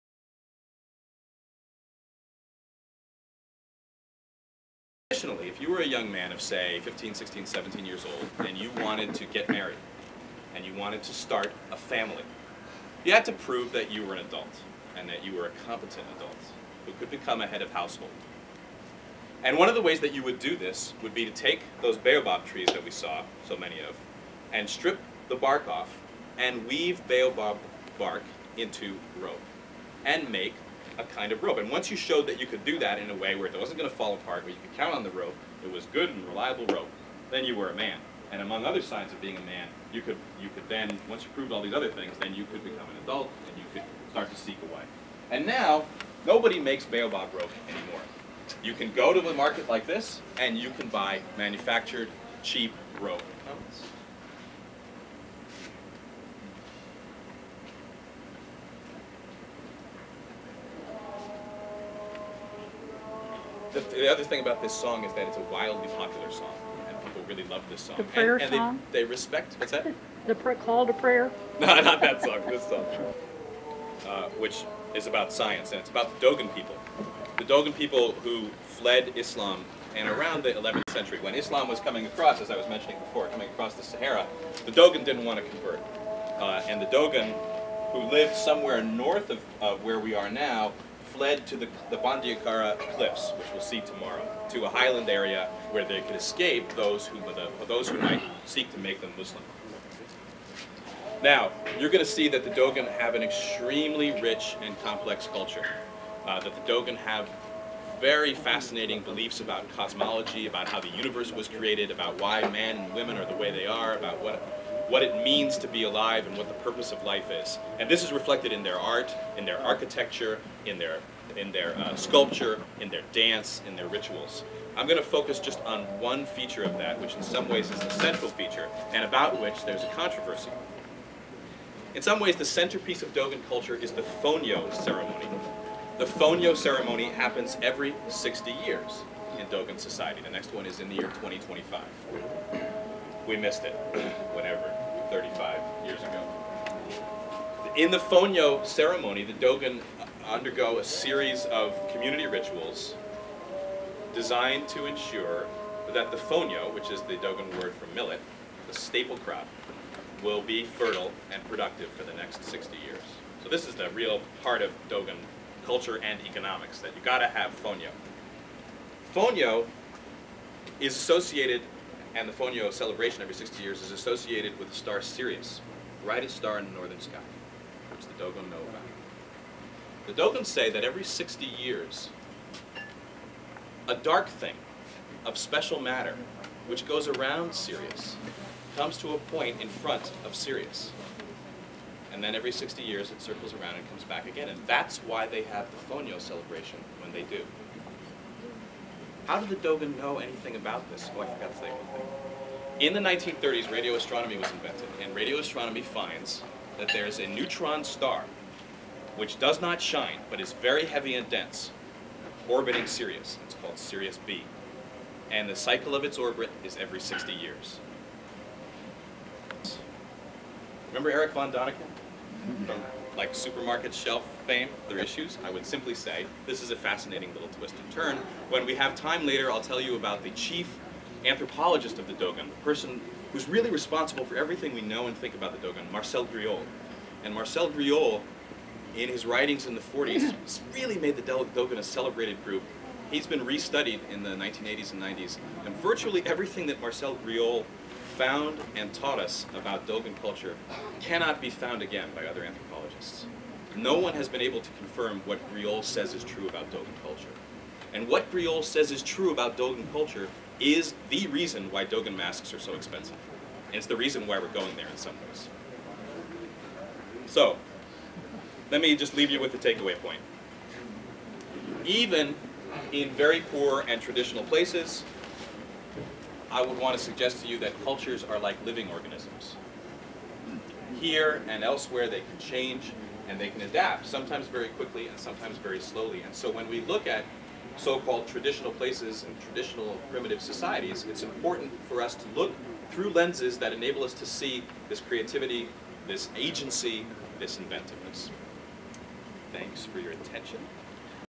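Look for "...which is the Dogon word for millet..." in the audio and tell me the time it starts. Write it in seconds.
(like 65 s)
156 s.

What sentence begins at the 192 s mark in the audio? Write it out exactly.
And then every 60 years it circles around and comes back again.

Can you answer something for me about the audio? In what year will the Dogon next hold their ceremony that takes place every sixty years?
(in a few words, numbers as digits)
2025.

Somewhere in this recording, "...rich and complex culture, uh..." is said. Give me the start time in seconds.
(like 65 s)
104 s.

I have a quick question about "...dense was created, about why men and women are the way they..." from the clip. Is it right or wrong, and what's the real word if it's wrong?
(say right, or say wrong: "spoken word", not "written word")
wrong: "universe", not "dense".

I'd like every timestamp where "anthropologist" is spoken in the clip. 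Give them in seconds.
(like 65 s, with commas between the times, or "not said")
231 s, 252 s.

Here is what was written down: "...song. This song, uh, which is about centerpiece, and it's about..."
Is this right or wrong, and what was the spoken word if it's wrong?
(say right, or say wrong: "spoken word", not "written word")
wrong: "science", not "centerpiece".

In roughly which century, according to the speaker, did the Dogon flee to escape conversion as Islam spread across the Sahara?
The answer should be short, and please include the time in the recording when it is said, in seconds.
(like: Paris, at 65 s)
11th century, at 80 s.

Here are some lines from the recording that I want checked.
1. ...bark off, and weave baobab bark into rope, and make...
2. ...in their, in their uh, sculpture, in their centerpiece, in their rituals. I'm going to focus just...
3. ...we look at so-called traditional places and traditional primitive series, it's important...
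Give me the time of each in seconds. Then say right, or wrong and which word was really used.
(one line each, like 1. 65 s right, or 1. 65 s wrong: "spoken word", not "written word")
1. 25 s right
2. 120 s wrong: "dance", not "centerpiece"
3. 286 s wrong: "societies", not "series".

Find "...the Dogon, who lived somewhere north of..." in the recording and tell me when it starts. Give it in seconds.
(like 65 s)
86 s.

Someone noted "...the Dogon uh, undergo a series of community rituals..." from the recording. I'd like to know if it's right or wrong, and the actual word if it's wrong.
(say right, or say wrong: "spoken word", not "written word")
right.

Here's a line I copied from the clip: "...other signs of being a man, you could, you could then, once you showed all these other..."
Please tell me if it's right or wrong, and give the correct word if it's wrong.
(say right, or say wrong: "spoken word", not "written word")
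wrong: "proved", not "showed".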